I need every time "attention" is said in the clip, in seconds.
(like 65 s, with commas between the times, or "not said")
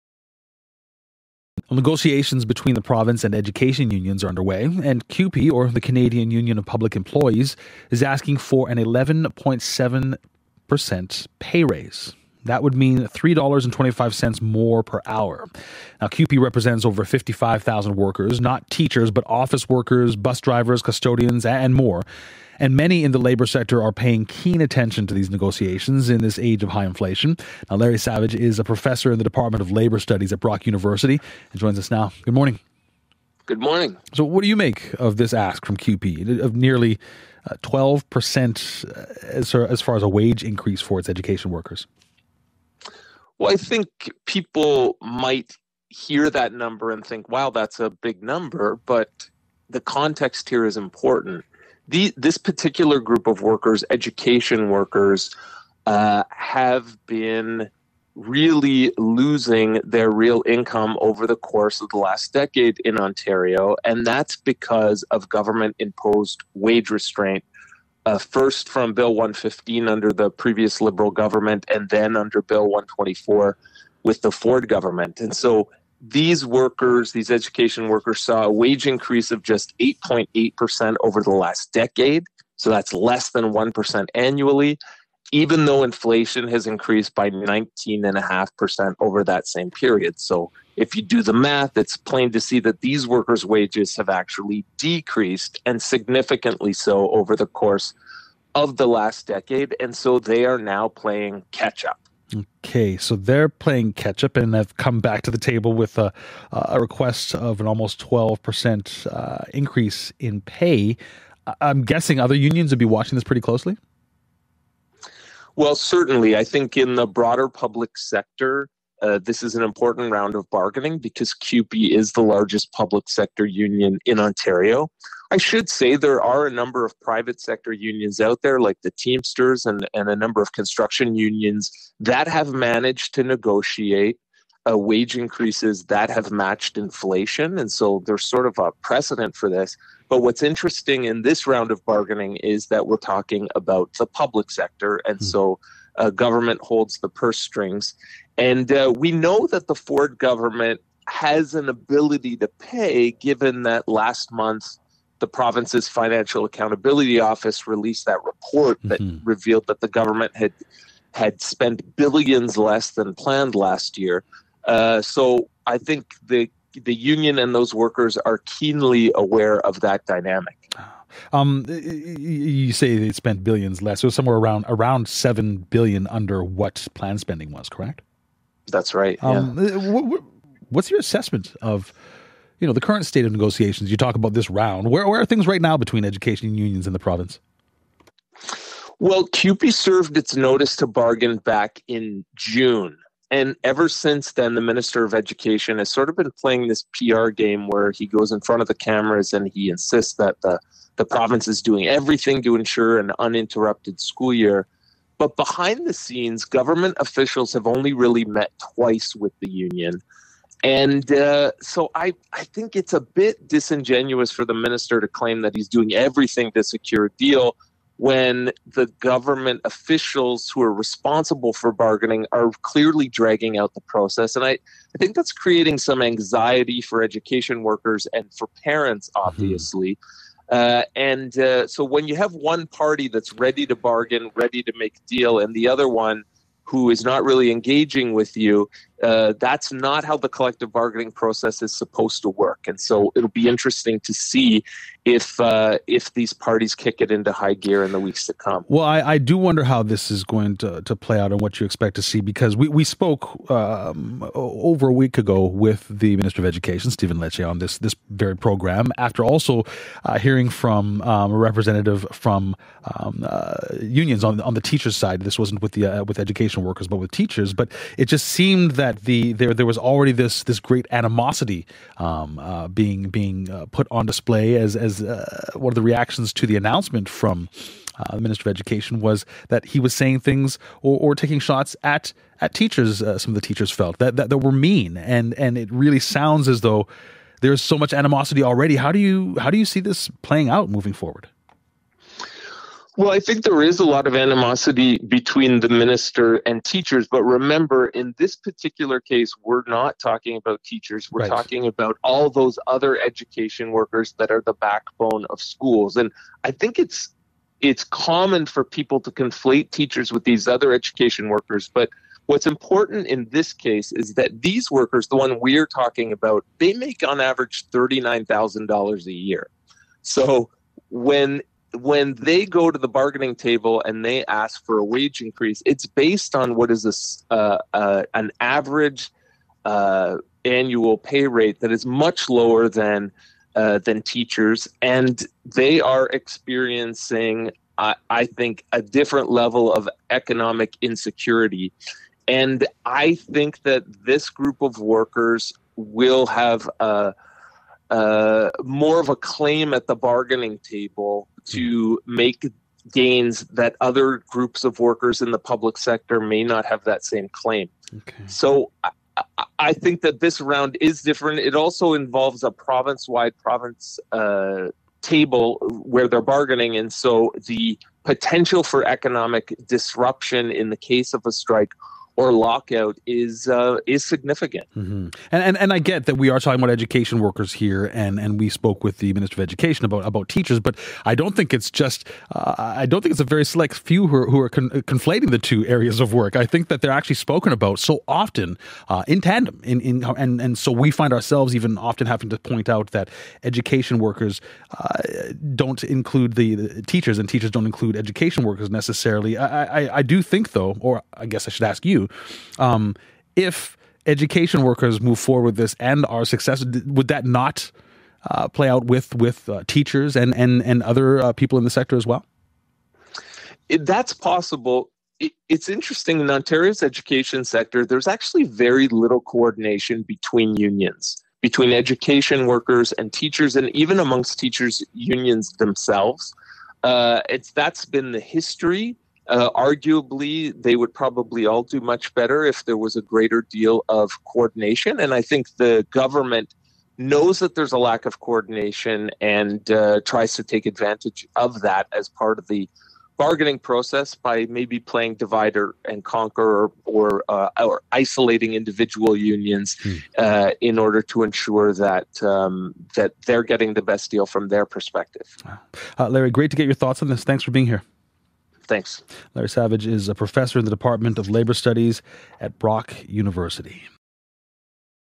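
24 s.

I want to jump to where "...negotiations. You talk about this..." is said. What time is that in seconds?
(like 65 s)
183 s.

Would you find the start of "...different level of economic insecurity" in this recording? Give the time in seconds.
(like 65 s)
338 s.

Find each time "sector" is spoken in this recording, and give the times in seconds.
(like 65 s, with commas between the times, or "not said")
23 s, 117 s, 123 s, 127 s, 144 s, 355 s, 411 s, 417 s.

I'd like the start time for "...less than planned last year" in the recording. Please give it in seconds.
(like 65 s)
162 s.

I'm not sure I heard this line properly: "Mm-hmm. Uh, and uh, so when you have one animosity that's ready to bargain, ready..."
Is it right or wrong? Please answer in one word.
wrong.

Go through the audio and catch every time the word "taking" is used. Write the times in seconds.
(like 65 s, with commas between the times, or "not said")
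281 s.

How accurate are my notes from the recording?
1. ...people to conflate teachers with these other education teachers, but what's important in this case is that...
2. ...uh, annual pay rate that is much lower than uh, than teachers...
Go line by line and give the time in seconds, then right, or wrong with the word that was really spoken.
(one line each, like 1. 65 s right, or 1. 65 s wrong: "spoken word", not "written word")
1. 308 s wrong: "workers", not "teachers"
2. 329 s right.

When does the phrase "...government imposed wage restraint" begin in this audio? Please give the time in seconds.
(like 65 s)
65 s.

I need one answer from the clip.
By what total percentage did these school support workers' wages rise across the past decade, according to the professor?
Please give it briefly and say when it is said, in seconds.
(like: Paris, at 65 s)
8.8%, at 79 s.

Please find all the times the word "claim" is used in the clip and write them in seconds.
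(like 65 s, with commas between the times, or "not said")
215 s, 349 s, 357 s.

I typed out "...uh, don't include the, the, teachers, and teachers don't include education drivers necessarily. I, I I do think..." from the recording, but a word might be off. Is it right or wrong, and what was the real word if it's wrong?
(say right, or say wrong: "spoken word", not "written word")
wrong: "workers", not "drivers".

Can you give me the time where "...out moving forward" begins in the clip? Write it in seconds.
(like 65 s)
290 s.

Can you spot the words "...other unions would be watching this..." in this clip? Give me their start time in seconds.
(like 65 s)
112 s.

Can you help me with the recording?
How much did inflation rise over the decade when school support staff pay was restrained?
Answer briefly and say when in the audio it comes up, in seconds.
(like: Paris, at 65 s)
19.5%, at 87 s.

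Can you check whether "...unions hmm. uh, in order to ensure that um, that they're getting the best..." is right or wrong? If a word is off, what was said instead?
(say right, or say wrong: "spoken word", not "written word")
right.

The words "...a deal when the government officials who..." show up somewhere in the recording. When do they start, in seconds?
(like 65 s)
217 s.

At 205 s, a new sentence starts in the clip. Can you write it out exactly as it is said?
But behind the scenes, government officials have only really met twice with the union.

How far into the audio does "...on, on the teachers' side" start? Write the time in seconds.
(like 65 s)
264 s.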